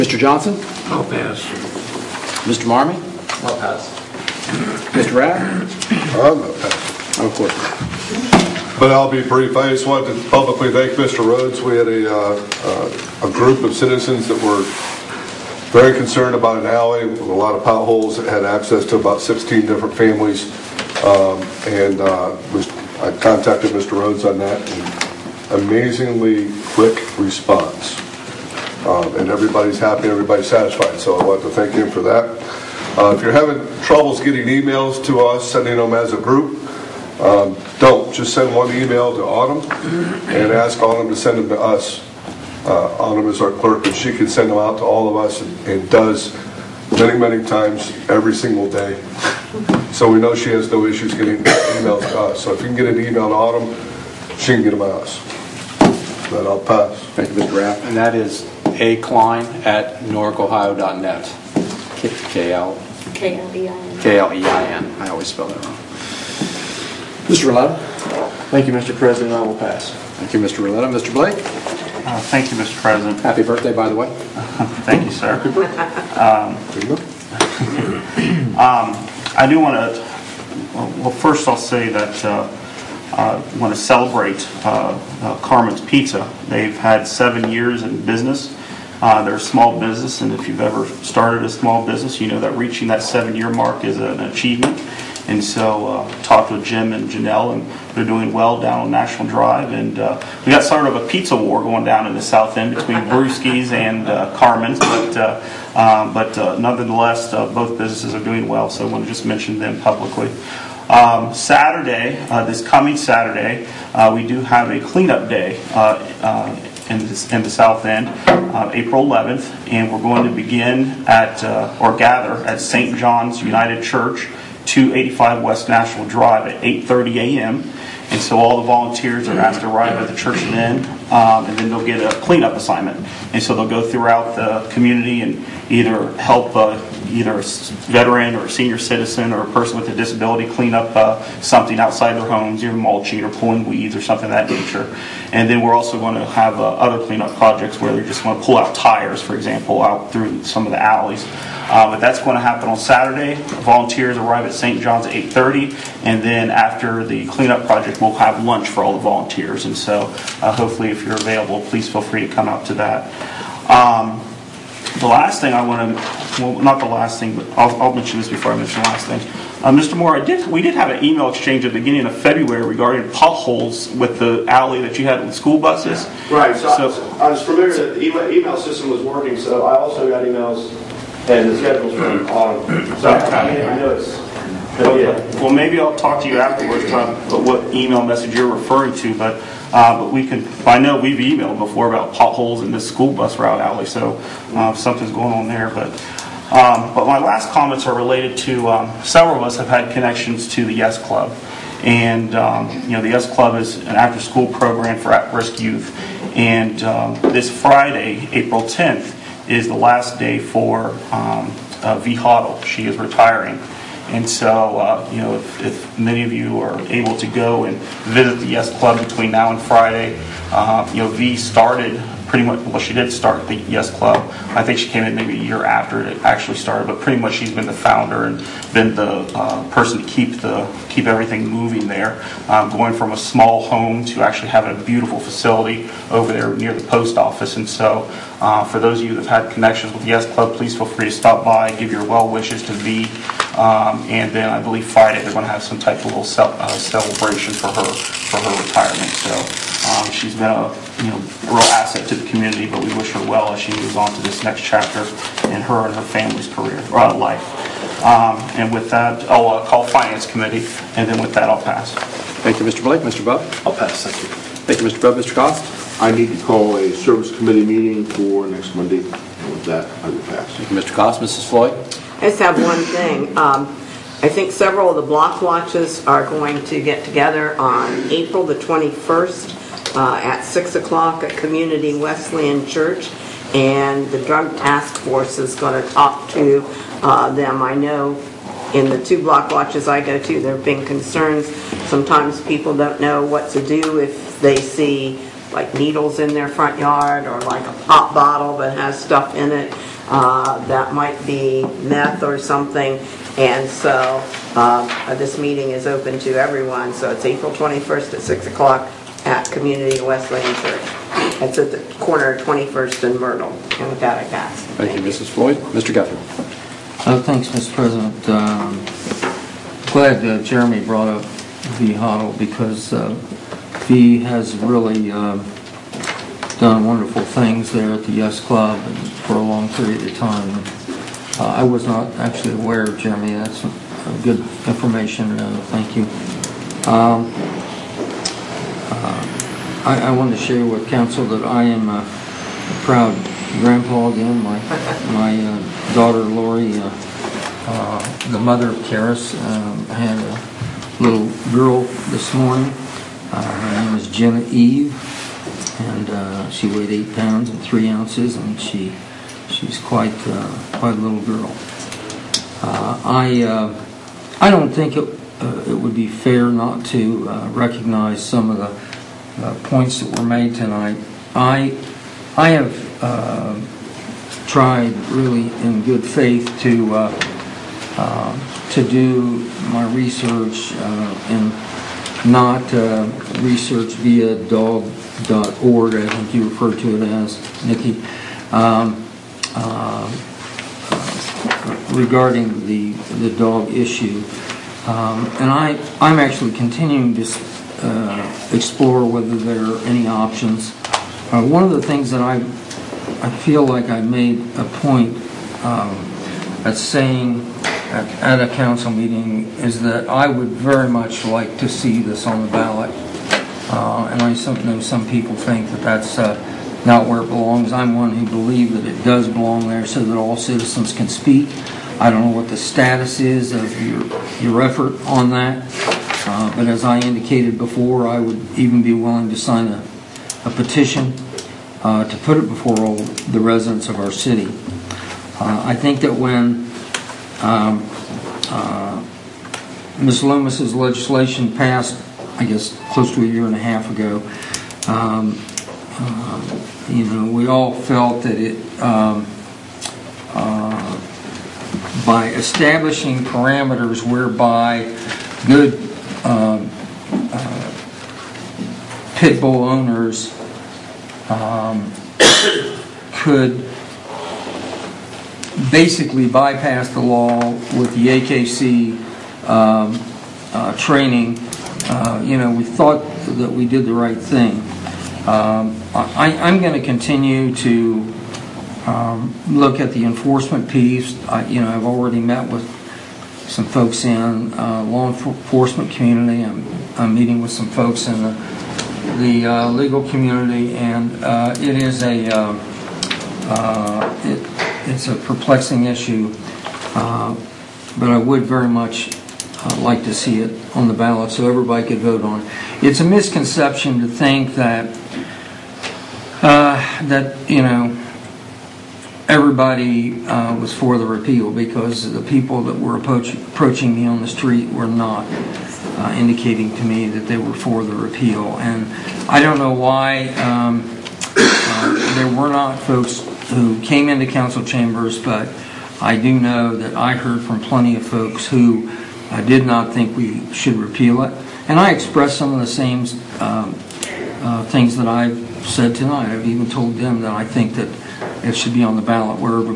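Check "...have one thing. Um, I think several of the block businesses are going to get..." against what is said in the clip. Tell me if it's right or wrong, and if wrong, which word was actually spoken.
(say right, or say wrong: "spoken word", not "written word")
wrong: "watches", not "businesses".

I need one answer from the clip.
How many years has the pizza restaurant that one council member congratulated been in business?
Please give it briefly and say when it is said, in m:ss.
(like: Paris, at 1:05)
7, at 1:27.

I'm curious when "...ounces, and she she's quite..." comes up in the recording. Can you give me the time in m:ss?
5:57.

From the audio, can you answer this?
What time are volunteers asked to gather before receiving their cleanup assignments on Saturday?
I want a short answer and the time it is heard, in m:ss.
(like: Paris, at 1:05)
8:30 a.m., at 2:06.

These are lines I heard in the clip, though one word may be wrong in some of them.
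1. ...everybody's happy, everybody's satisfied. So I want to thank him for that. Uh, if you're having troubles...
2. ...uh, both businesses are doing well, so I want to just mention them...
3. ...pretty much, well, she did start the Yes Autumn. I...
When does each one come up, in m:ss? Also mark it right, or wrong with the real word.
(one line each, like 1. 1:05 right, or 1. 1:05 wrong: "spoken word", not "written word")
1. 0:29 right
2. 1:47 right
3. 3:42 wrong: "Club", not "Autumn".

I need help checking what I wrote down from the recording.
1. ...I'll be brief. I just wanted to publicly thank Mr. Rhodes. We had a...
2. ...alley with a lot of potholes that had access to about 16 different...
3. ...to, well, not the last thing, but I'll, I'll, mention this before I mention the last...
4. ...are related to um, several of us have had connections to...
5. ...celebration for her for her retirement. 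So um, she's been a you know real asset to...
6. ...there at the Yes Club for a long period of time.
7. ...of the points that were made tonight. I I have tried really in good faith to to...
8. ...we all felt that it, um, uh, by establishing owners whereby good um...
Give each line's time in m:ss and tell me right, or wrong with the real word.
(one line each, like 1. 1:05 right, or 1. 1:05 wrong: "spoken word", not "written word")
1. 0:08 right
2. 0:16 right
3. 2:45 right
4. 3:17 right
5. 4:06 right
6. 5:27 right
7. 6:08 right
8. 7:27 wrong: "parameters", not "owners".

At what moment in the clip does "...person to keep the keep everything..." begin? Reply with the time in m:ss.
3:49.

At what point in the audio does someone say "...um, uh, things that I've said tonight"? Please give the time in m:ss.
8:53.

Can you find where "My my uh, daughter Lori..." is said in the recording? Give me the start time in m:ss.
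5:44.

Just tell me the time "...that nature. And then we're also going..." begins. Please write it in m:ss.
2:24.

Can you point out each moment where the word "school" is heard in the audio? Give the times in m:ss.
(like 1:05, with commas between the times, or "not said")
2:55, 3:12, 3:24.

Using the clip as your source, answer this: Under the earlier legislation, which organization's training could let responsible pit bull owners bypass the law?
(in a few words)
AKC.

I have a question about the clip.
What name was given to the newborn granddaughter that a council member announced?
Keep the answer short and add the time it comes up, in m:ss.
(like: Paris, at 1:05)
Jenna Eve, at 5:54.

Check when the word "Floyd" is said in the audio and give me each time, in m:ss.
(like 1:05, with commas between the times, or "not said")
4:31, 5:15.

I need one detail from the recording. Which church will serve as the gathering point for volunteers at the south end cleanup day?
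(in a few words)
St. John's United Church.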